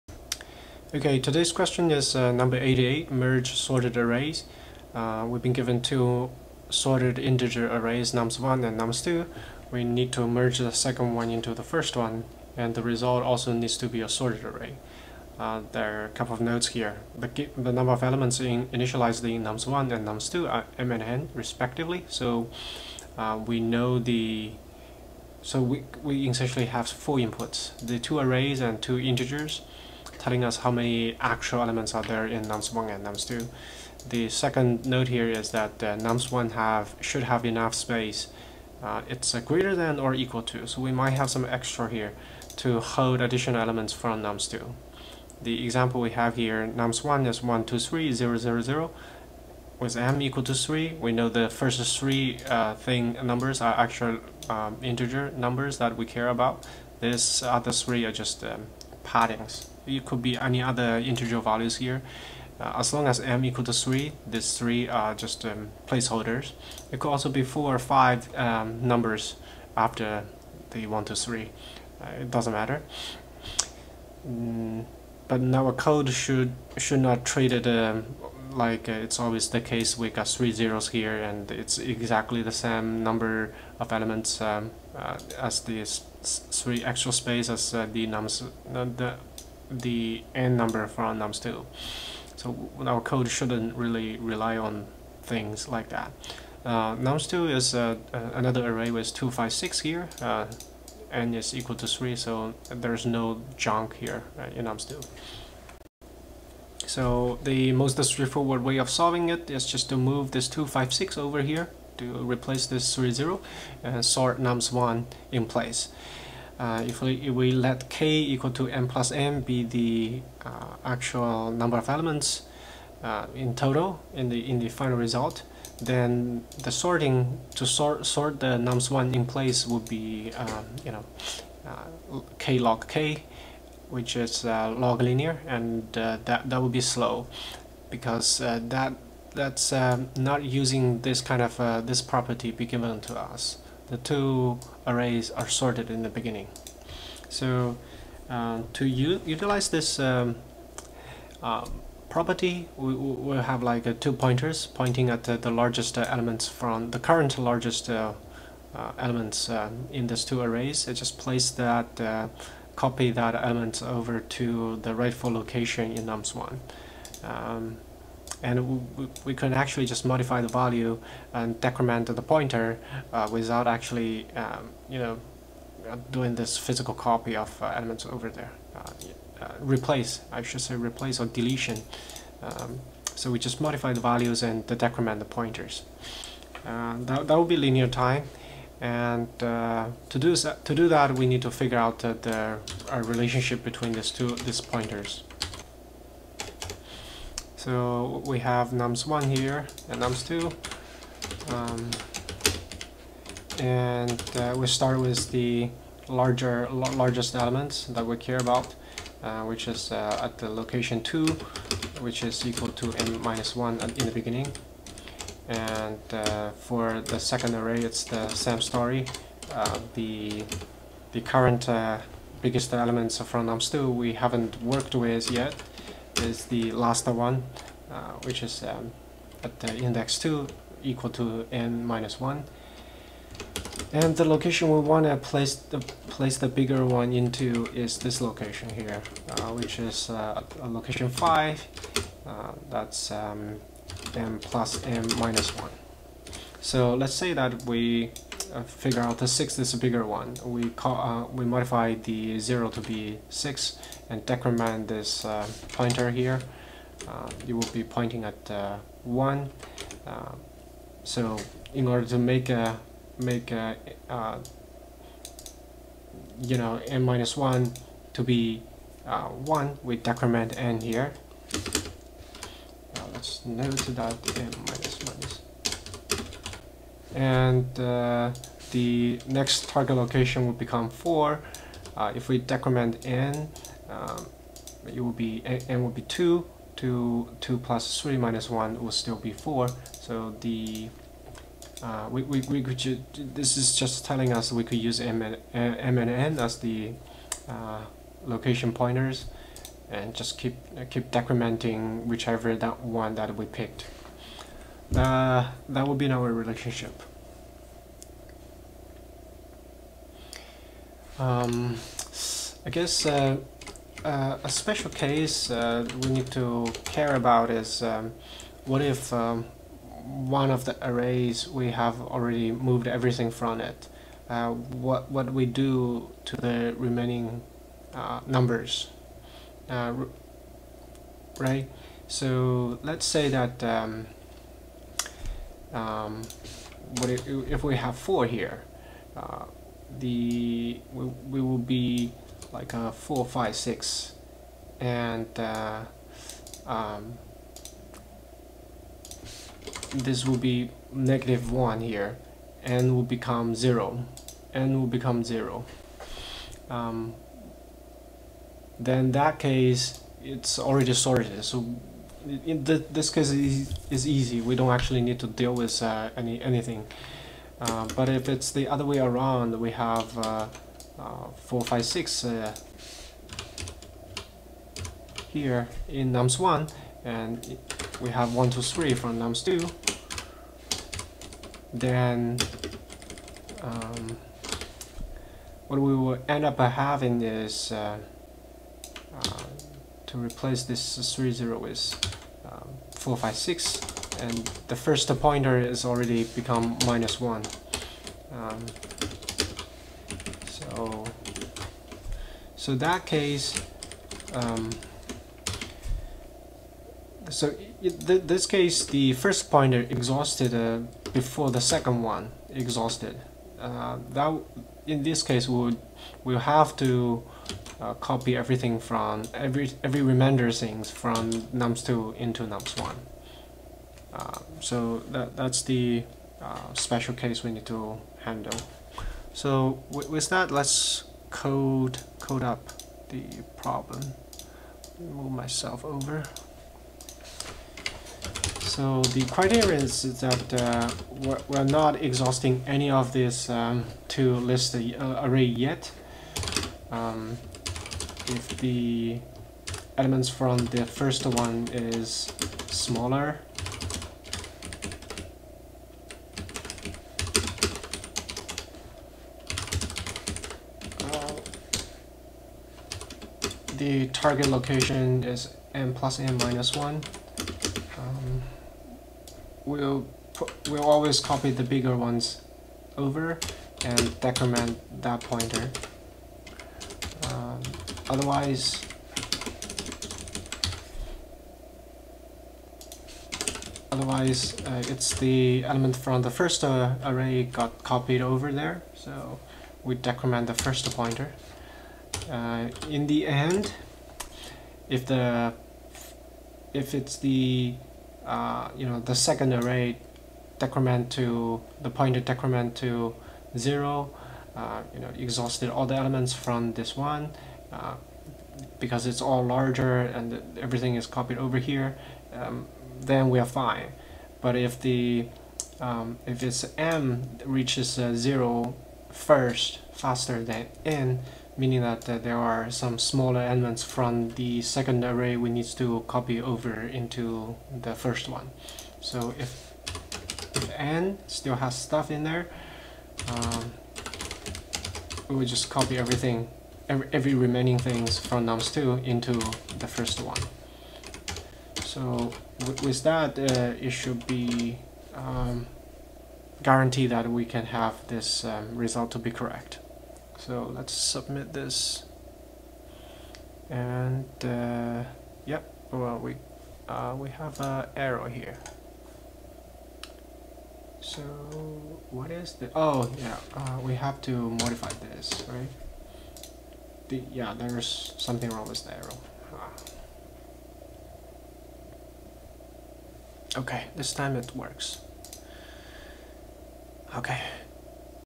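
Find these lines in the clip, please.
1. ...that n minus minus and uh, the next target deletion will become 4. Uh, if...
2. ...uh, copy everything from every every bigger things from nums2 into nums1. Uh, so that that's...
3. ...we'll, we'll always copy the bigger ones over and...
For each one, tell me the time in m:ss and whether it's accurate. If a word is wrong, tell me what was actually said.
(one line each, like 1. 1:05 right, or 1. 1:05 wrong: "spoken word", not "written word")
1. 4:33 wrong: "location", not "deletion"
2. 6:57 wrong: "remainder", not "bigger"
3. 7:49 right.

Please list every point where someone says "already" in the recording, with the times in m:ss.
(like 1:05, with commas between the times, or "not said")
5:22, 6:00, 6:35.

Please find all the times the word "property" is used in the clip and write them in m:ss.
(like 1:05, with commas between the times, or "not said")
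2:22, 2:32.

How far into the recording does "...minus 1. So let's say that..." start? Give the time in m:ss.
4:05.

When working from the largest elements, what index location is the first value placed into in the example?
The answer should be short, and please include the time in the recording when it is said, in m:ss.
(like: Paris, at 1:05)
5, at 4:00.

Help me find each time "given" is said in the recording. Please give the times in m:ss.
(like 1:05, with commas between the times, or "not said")
0:05, 2:22.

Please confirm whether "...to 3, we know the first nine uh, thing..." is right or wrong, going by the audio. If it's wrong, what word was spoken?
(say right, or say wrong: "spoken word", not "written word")
wrong: "three", not "nine".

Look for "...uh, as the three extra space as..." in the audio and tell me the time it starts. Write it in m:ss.
1:24.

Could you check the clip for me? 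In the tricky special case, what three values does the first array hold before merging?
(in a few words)
4, 5, 6.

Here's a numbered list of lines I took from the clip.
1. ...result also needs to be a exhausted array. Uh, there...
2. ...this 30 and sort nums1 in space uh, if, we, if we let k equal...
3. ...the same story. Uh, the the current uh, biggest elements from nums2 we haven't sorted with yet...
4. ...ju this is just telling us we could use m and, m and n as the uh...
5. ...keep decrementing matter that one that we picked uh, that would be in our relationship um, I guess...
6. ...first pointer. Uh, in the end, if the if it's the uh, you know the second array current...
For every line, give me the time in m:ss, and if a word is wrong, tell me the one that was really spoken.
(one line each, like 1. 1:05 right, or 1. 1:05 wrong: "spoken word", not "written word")
1. 0:12 wrong: "sorted", not "exhausted"
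2. 1:52 wrong: "place", not "space"
3. 3:38 wrong: "worked", not "sorted"
4. 4:52 right
5. 5:00 wrong: "whichever", not "matter"
6. 8:10 wrong: "decrement", not "current".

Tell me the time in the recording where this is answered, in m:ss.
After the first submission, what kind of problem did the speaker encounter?
9:17.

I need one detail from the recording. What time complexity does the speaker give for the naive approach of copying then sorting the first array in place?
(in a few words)
k log k.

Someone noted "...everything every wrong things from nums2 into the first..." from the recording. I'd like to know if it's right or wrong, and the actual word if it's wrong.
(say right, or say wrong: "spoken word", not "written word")
wrong: "remaining", not "wrong".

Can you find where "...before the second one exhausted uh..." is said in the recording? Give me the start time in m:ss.
6:51.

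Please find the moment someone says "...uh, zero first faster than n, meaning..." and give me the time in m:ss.
8:37.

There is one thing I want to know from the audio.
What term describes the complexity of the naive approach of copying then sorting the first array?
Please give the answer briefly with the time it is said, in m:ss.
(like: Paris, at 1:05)
log linear, at 2:14.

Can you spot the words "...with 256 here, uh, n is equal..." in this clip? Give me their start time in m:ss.
1:38.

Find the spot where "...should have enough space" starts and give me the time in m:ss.
0:37.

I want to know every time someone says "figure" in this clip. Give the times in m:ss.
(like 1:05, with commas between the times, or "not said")
3:11, 4:08.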